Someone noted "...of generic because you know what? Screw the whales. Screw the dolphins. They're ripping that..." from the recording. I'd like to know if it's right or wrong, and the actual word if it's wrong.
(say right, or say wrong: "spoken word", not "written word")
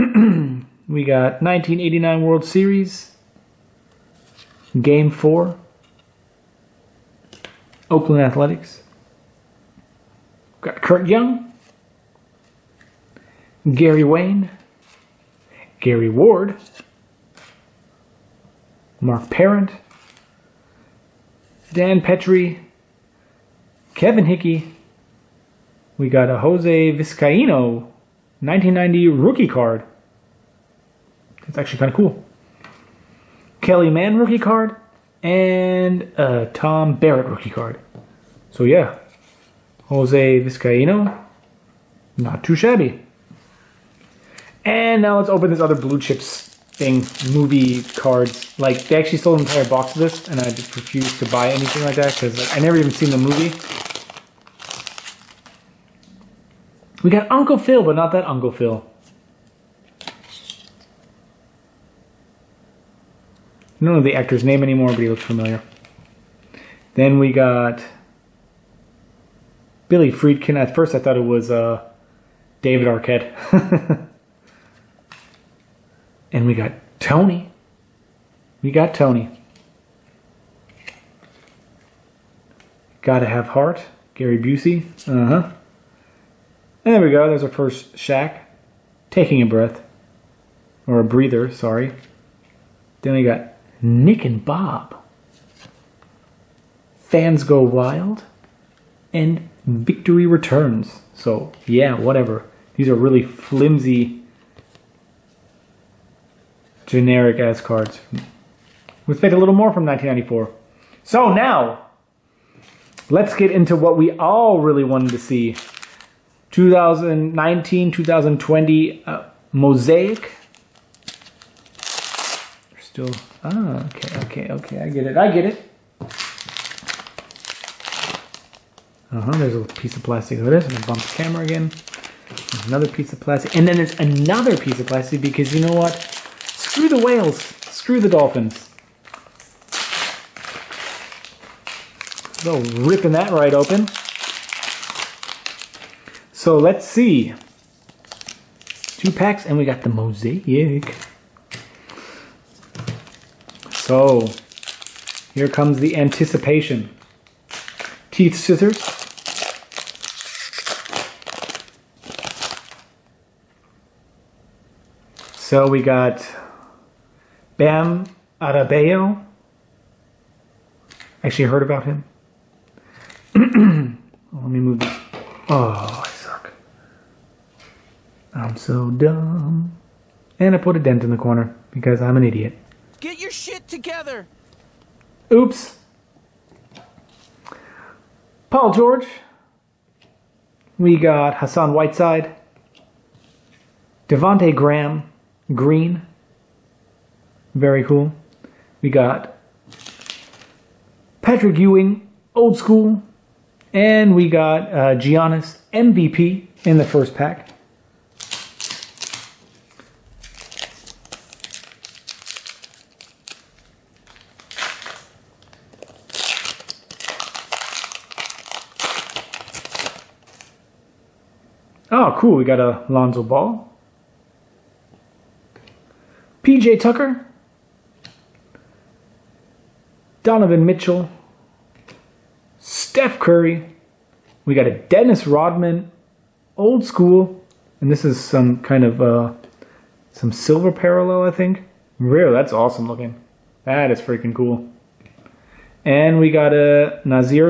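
wrong: "plastic", not "generic".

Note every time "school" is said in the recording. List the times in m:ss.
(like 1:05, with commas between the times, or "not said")
3:22, 3:56.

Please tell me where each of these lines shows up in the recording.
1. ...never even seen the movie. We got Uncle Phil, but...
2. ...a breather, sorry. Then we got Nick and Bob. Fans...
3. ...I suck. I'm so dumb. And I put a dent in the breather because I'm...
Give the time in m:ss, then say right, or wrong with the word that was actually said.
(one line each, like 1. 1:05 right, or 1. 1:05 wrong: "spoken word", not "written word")
1. 0:52 right
2. 1:31 right
3. 2:56 wrong: "corner", not "breather".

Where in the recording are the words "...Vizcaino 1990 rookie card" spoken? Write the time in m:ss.
0:26.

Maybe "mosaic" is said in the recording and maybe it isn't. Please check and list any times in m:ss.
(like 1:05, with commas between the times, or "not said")
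1:59, 2:29.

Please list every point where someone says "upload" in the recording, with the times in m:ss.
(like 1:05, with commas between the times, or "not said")
not said.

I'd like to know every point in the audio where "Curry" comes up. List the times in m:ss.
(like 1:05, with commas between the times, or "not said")
3:53.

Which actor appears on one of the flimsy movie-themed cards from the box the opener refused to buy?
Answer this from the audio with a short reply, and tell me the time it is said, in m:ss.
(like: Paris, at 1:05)
Gary Busey, at 1:24.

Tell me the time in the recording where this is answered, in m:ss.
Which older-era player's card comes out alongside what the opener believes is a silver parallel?
3:54.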